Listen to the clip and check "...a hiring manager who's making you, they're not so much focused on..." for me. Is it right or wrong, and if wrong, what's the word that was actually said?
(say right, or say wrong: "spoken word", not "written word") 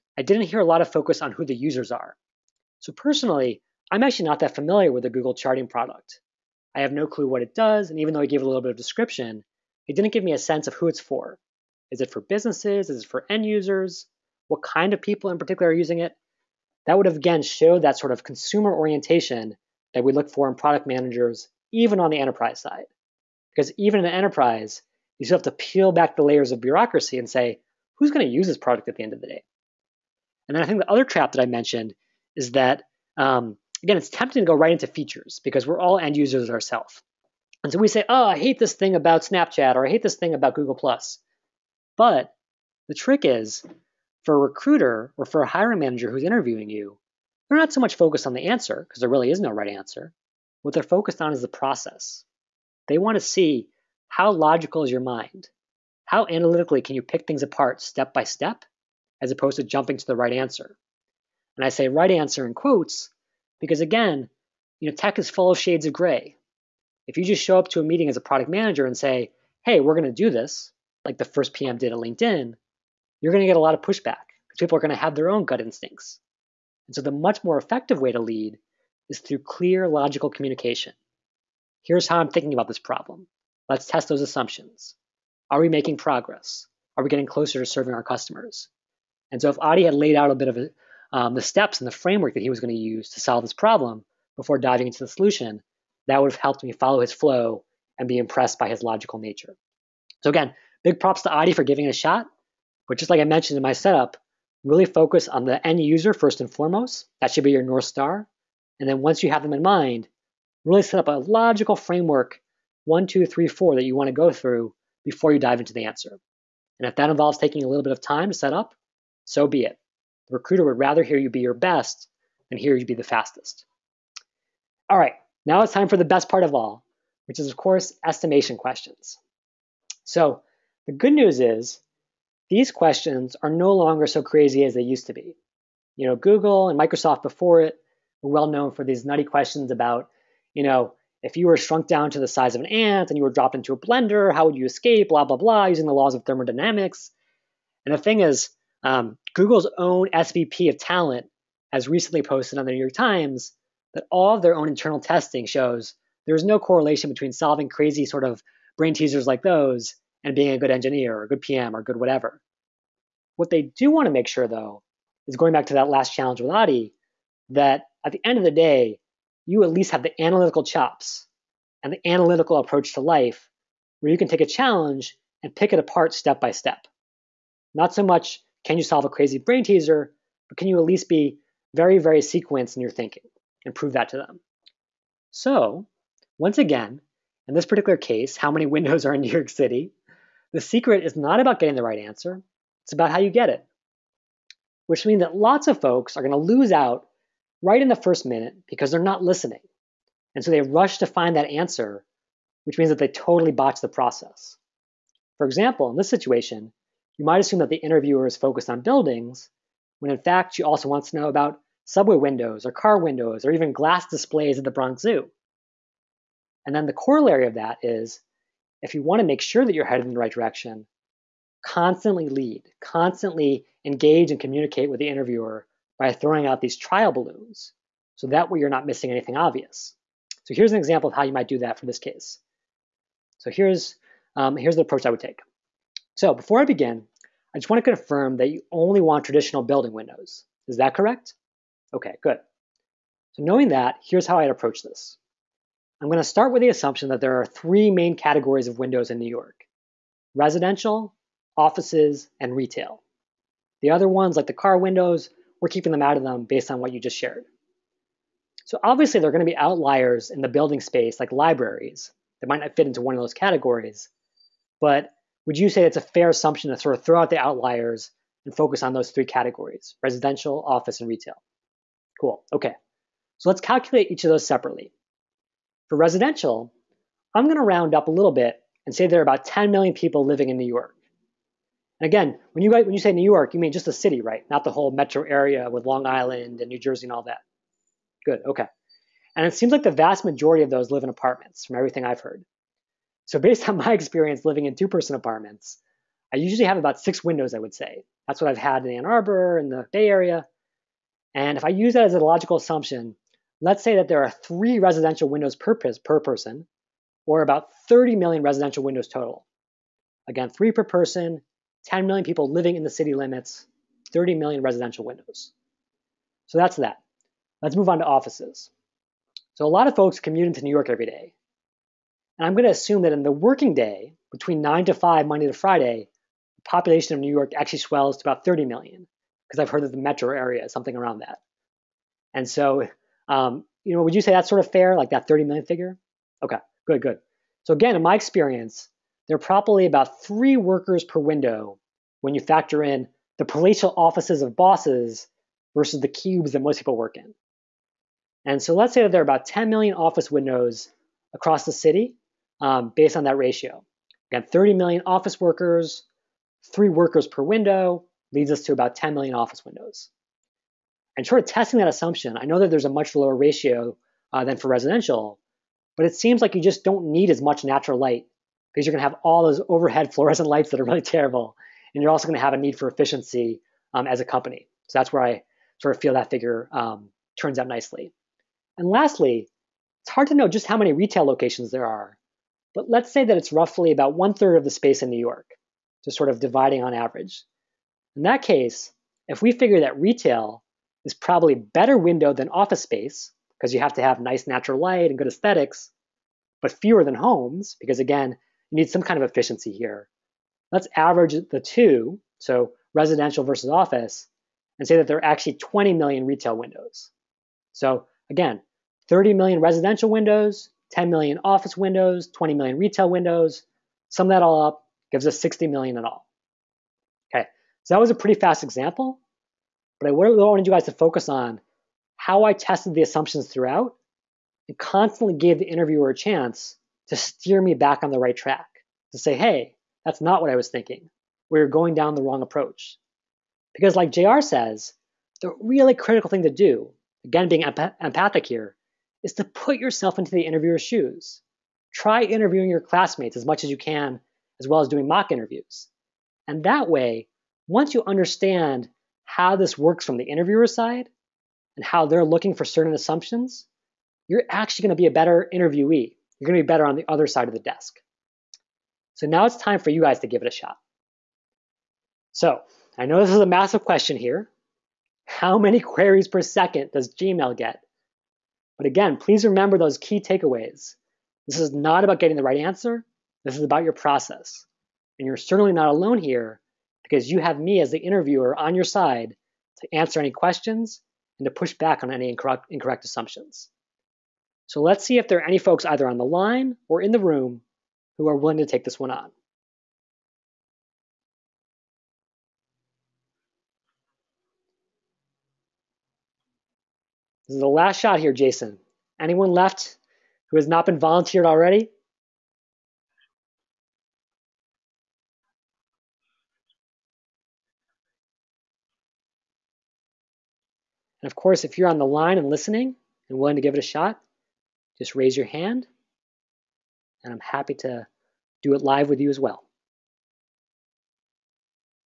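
wrong: "interviewing", not "making".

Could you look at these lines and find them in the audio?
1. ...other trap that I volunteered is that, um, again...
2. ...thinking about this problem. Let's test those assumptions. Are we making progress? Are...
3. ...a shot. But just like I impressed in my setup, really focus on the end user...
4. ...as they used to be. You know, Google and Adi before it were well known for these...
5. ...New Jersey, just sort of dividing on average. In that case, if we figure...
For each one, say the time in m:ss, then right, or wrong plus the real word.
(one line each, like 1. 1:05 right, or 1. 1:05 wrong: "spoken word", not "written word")
1. 0:30 wrong: "mentioned", not "volunteered"
2. 1:22 right
3. 1:41 wrong: "mentioned", not "impressed"
4. 2:14 wrong: "Microsoft", not "Adi"
5. 6:25 wrong: "York", not "Jersey".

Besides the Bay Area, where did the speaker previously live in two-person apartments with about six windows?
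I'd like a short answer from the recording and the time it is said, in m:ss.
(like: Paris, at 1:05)
Ann Arbor, at 4:58.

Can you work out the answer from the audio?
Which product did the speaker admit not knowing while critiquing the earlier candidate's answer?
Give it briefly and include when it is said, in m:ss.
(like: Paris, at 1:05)
Google charting product, at 0:05.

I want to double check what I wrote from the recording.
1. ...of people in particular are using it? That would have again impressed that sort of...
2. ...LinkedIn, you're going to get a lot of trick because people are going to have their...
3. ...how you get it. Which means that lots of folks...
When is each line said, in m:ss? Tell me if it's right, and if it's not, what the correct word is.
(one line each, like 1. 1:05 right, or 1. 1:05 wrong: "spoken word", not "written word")
1. 0:14 wrong: "showed", not "impressed"
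2. 1:11 wrong: "pushback", not "trick"
3. 3:13 right.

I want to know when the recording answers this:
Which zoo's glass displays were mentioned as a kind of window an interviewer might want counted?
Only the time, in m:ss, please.
3:34.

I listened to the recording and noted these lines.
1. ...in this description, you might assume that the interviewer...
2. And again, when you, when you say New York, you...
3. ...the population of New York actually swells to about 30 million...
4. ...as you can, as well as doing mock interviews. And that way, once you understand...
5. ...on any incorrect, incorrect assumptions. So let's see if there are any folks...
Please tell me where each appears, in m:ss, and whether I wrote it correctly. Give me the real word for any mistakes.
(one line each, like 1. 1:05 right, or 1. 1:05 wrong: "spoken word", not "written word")
1. 3:25 wrong: "situation", not "description"
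2. 4:41 right
3. 5:26 right
4. 7:23 right
5. 8:02 right.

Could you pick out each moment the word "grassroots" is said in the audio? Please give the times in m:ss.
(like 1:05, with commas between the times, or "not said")
not said.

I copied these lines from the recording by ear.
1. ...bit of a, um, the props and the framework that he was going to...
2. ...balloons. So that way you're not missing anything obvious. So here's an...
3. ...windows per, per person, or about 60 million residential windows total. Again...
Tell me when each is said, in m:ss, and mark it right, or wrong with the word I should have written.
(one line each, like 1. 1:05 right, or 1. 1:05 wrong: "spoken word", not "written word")
1. 1:30 wrong: "steps", not "props"
2. 3:47 right
3. 5:05 wrong: "30", not "60".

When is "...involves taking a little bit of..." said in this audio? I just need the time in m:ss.
1:57.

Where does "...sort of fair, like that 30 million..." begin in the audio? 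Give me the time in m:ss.
5:34.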